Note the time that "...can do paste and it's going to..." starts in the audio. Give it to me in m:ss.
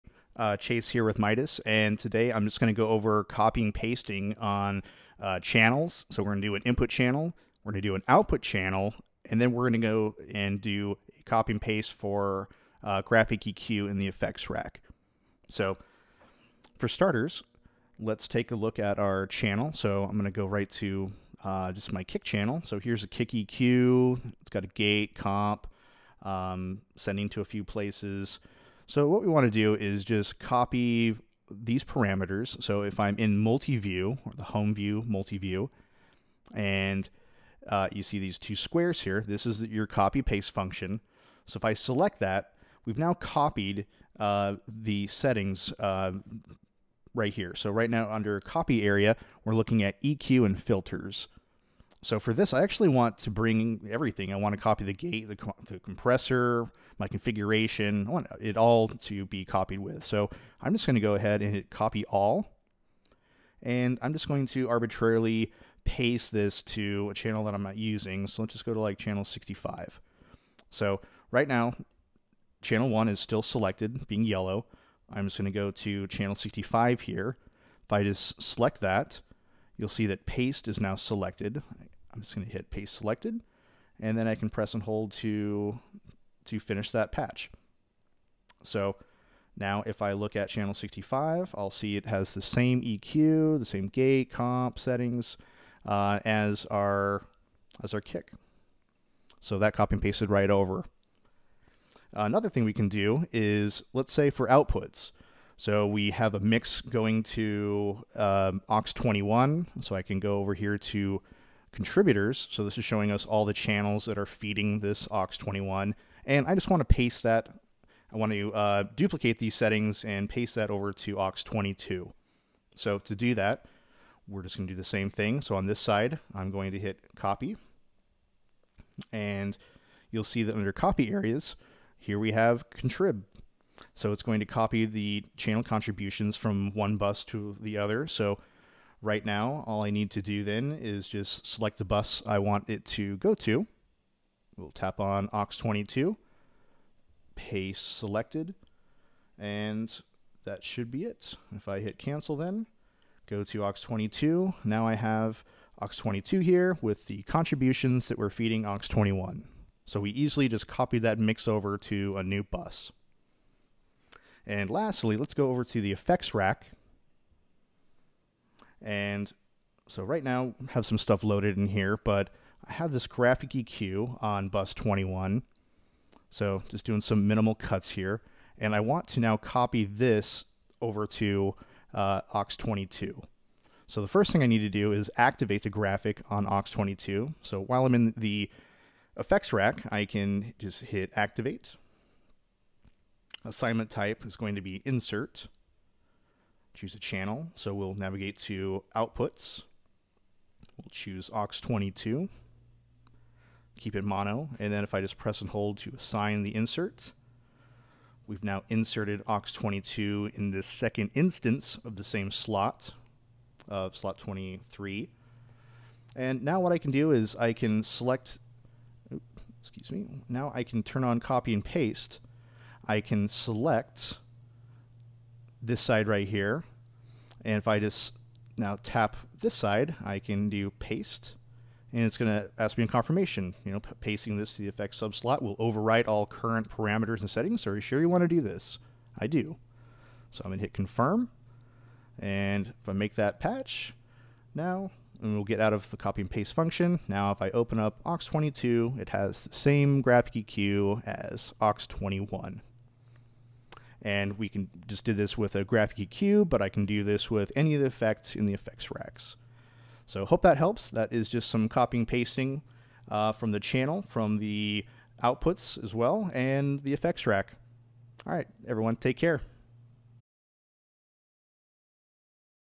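3:50.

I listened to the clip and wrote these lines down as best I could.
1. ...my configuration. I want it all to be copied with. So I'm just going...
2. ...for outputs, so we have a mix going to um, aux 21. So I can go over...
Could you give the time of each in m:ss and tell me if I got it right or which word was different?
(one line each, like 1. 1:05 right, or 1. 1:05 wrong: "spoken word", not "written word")
1. 0:57 right
2. 1:44 right.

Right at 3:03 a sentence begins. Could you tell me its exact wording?
So the first thing I need to do is activate the graphic on aux 22.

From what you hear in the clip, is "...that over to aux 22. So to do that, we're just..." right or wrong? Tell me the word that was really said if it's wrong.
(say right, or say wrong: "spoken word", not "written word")
right.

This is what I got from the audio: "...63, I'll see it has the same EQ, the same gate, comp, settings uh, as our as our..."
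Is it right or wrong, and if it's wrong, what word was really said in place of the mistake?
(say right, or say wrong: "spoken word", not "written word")
wrong: "65", not "63".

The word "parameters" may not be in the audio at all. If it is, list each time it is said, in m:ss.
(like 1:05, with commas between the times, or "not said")
0:31, 3:56.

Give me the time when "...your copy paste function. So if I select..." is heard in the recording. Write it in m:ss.
0:39.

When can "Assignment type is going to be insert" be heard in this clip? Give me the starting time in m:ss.
3:13.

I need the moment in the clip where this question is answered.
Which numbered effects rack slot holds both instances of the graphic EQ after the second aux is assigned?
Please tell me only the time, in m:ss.
3:33.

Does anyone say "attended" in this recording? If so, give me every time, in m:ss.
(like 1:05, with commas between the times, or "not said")
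not said.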